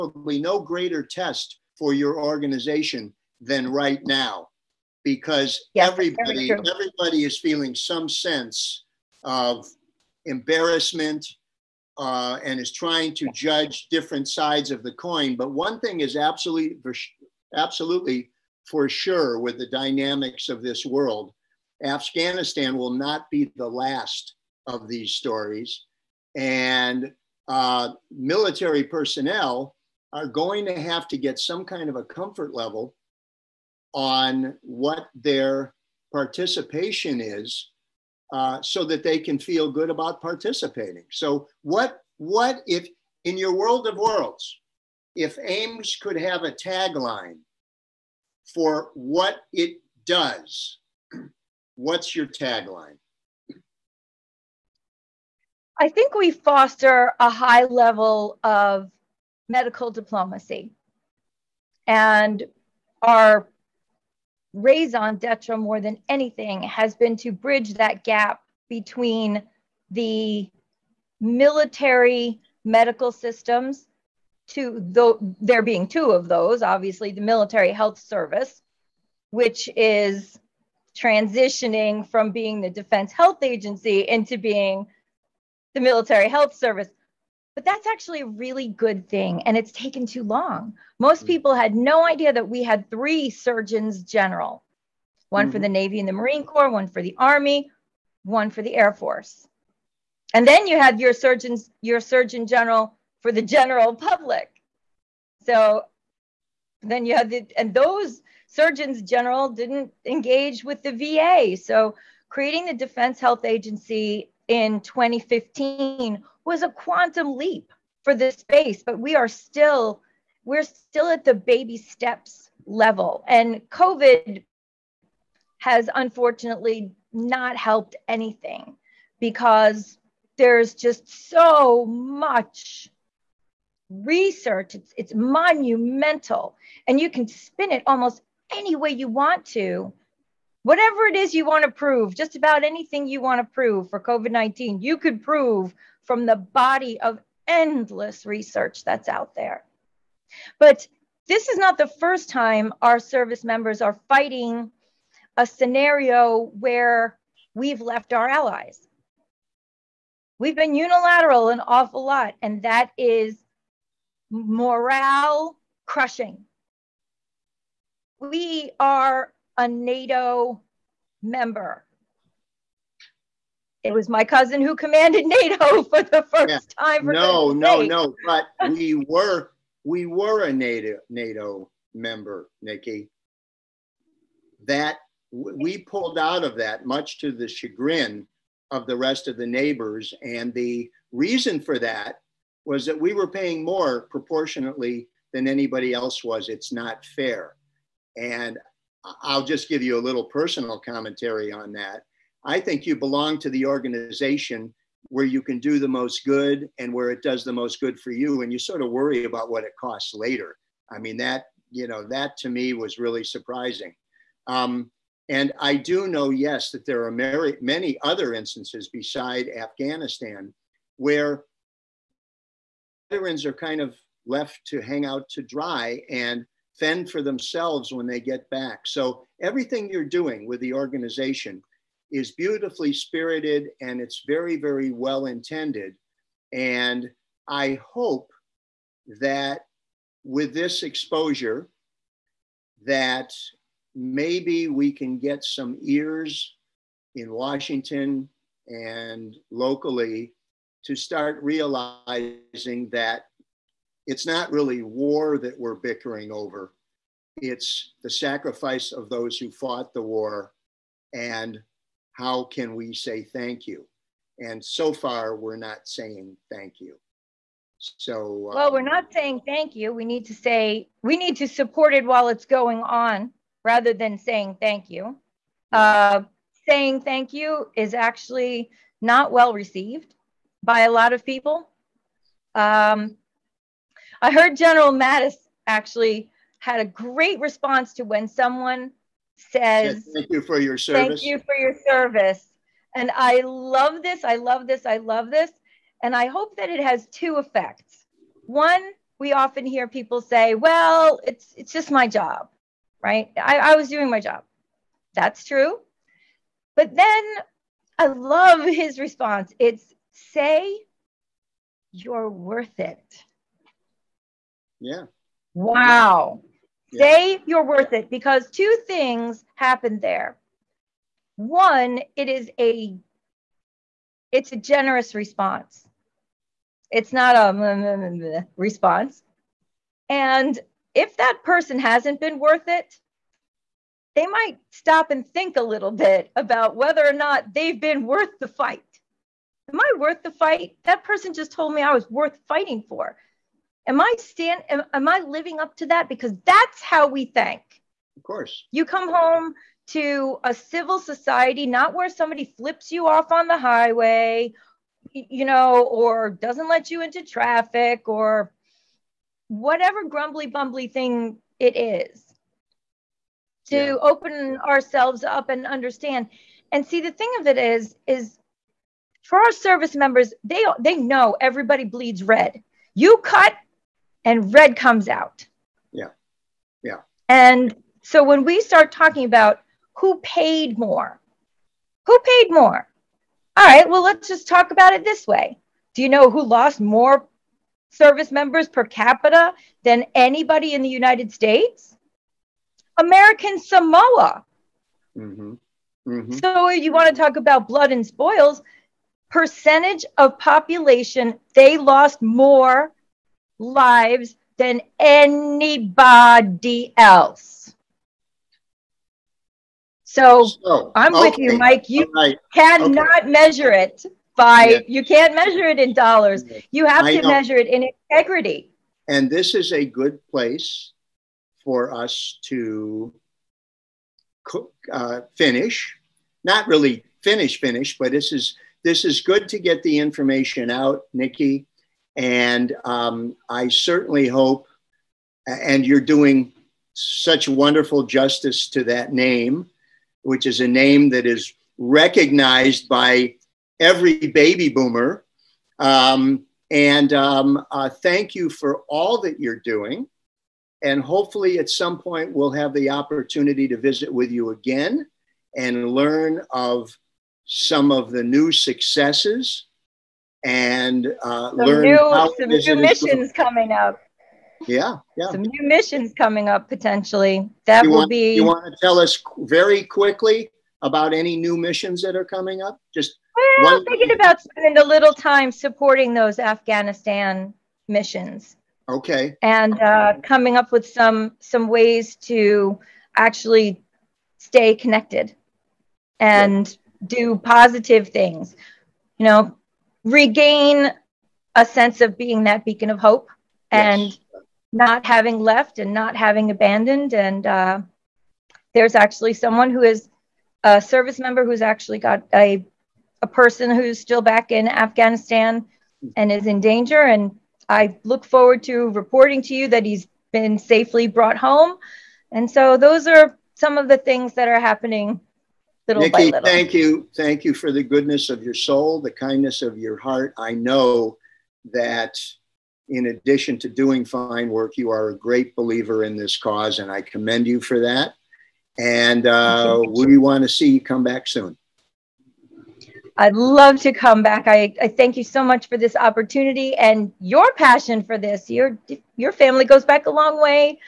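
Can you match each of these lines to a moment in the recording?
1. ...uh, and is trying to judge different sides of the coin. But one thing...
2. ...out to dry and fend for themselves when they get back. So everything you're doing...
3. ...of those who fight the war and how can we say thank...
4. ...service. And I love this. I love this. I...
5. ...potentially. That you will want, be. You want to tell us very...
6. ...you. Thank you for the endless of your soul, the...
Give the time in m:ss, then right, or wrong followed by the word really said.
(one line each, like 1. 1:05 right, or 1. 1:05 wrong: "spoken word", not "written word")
1. 0:11 right
2. 3:45 right
3. 4:18 wrong: "fought", not "fight"
4. 4:51 right
5. 7:46 right
6. 8:36 wrong: "goodness", not "endless".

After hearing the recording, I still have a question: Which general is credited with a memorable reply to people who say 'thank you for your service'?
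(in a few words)
General Mattis.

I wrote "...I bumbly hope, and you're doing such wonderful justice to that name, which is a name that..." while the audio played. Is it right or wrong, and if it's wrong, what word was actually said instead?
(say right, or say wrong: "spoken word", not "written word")
wrong: "certainly", not "bumbly".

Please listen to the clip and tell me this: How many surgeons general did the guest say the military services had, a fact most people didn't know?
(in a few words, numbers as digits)
3.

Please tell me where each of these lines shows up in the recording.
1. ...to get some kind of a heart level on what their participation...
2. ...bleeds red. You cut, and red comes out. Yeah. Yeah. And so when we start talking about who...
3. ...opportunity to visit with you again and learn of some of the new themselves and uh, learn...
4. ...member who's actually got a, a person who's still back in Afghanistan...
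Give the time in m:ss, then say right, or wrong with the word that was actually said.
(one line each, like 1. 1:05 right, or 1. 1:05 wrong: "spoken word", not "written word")
1. 0:31 wrong: "comfort", not "heart"
2. 6:11 right
3. 7:32 wrong: "successes", not "themselves"
4. 8:21 right.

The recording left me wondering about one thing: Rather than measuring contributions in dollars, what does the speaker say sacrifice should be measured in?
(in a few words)
Integrity.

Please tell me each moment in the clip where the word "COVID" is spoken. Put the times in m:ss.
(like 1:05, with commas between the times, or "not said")
2:03, 2:23.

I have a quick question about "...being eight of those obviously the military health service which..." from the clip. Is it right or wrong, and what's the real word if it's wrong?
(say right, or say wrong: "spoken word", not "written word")
wrong: "two", not "eight".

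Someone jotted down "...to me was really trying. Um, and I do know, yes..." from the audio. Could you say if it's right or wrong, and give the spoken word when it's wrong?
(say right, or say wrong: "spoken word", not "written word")
wrong: "surprising", not "trying".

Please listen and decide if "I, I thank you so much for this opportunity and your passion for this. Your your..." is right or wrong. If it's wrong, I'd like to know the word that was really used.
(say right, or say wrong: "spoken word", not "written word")
right.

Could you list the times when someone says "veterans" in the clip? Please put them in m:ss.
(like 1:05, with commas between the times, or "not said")
3:43.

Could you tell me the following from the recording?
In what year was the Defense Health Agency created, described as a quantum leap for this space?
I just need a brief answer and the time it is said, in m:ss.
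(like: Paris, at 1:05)
2015, at 1:54.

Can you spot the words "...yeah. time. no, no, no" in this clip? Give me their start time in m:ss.
2:56.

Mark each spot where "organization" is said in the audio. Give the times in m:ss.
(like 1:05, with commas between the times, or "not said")
0:02, 3:23, 3:50.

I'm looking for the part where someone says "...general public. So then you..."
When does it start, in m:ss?
1:43.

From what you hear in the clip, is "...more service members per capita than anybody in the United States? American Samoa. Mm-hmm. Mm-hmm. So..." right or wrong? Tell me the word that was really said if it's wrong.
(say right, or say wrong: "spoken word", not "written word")
right.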